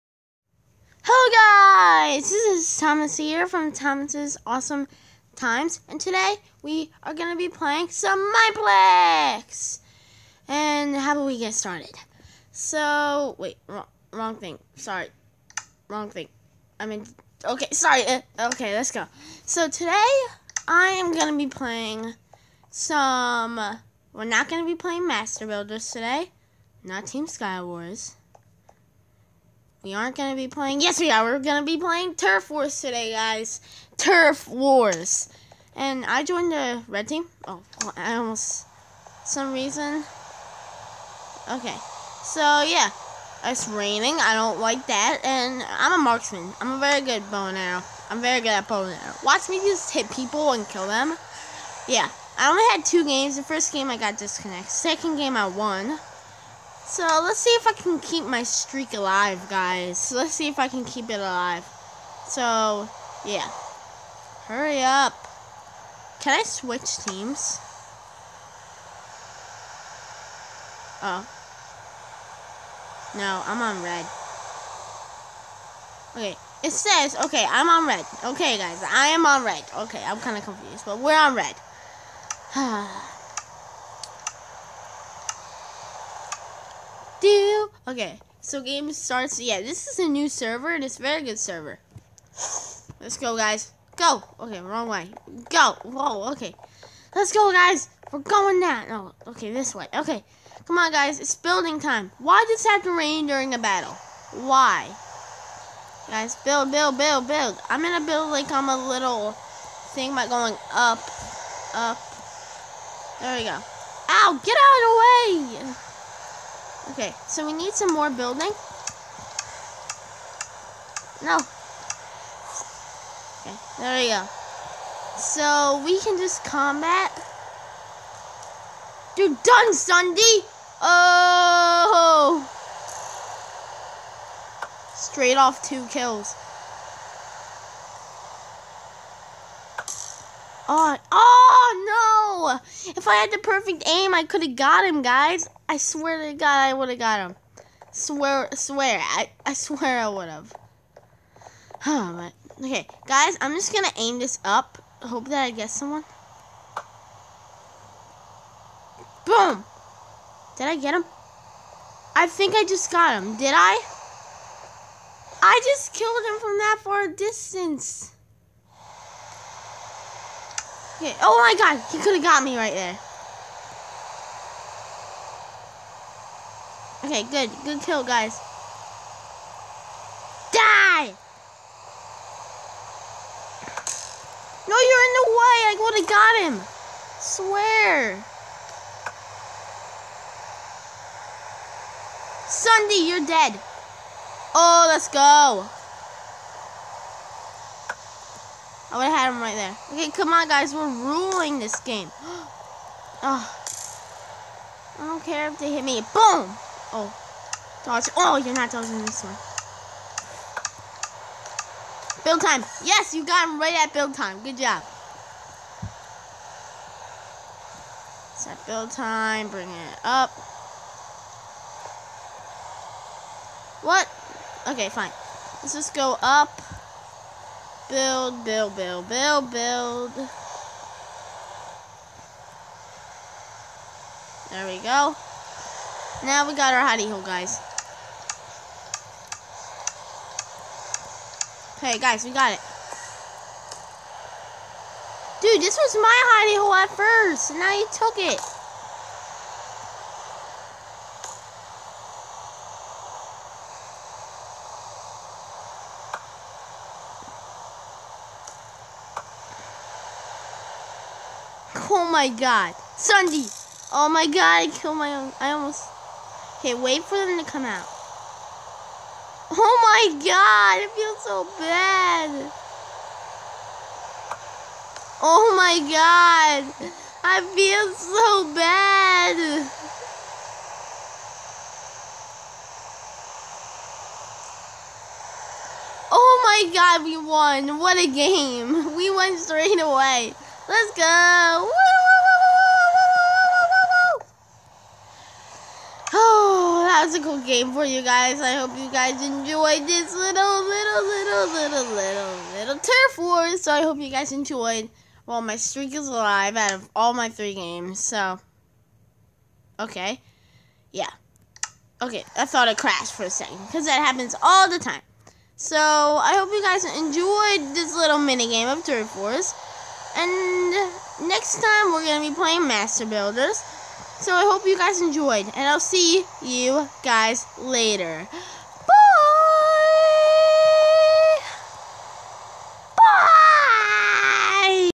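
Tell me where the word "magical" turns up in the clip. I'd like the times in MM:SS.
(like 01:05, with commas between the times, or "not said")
not said.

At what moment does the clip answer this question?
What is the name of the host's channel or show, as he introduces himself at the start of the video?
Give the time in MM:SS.
00:03.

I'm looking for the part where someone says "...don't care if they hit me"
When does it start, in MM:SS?
03:25.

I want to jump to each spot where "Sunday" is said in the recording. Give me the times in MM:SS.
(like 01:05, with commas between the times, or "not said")
02:09, 03:12, 04:22.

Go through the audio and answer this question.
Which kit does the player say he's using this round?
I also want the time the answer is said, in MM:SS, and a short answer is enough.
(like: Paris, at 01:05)
Marksman, at 00:46.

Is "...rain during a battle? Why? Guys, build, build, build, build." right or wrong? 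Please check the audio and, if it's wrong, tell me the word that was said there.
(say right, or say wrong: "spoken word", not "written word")
right.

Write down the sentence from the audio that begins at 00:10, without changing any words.
And how about we get started?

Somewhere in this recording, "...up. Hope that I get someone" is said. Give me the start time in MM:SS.
02:34.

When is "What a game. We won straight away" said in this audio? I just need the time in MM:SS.
04:47.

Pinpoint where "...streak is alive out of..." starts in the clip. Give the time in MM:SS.
05:05.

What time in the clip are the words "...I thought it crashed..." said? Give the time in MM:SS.
05:12.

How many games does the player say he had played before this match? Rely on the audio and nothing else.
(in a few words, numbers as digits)
2.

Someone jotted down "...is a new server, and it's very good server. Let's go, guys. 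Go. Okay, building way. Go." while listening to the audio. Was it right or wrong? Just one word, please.
wrong.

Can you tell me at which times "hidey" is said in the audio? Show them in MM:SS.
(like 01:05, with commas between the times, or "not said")
03:56, 04:06.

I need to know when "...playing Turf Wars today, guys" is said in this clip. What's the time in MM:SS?
00:31.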